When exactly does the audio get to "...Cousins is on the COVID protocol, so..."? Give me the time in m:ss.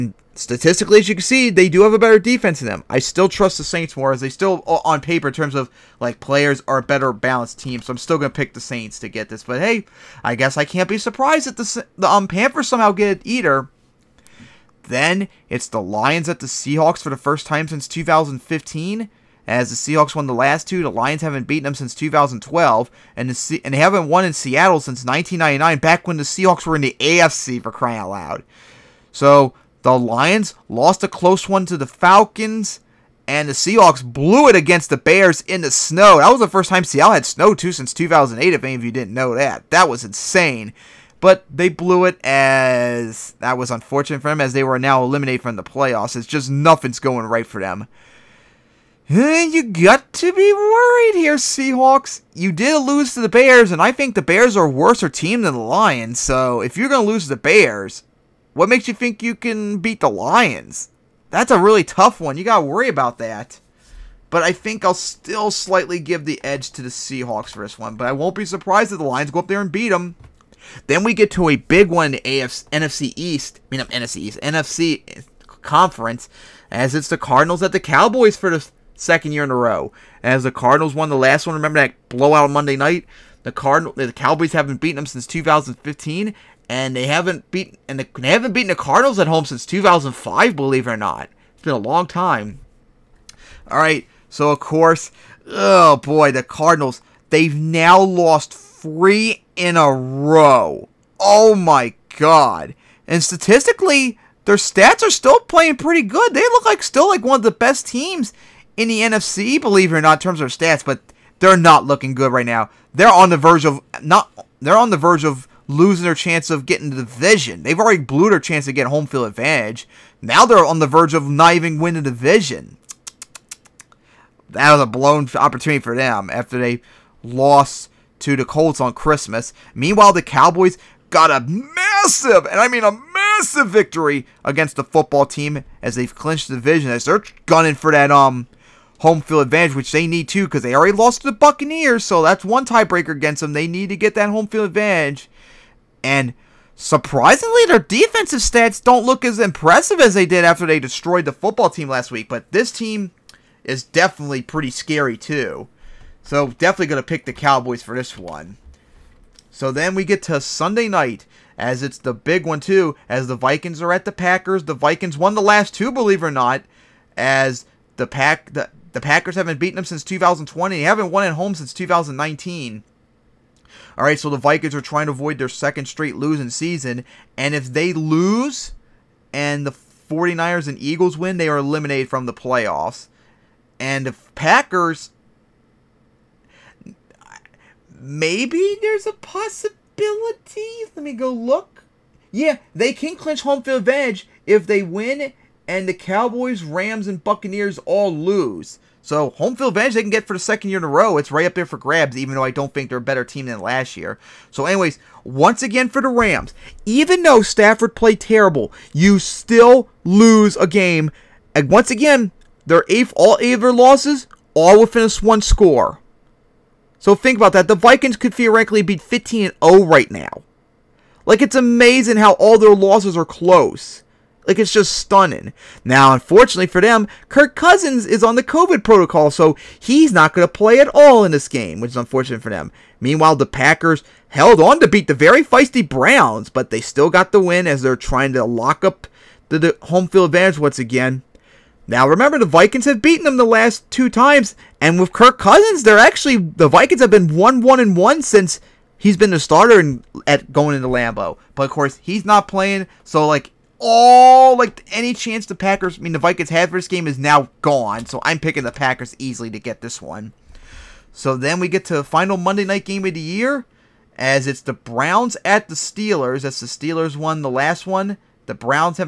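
3:47.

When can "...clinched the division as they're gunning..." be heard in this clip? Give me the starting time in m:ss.
2:16.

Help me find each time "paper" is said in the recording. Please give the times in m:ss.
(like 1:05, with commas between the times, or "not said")
0:04.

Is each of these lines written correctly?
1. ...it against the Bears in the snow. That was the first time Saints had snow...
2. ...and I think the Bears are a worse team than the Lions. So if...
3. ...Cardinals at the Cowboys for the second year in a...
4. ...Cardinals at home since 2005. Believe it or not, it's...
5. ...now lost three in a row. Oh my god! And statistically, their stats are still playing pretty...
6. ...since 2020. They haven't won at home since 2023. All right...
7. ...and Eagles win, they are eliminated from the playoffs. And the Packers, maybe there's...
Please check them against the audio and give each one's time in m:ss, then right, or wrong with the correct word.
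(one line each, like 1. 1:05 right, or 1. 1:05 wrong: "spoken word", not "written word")
1. 0:34 wrong: "Seattle", not "Saints"
2. 0:53 right
3. 1:17 right
4. 1:28 right
5. 1:37 right
6. 2:49 wrong: "2019", not "2023"
7. 3:00 right.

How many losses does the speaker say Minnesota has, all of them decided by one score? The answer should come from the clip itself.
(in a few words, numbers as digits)
8.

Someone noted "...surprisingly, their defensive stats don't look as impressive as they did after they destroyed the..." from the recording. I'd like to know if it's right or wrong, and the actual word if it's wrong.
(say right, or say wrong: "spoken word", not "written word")
right.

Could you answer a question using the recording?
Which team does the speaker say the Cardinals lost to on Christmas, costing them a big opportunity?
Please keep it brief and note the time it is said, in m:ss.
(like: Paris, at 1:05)
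Colts, at 2:08.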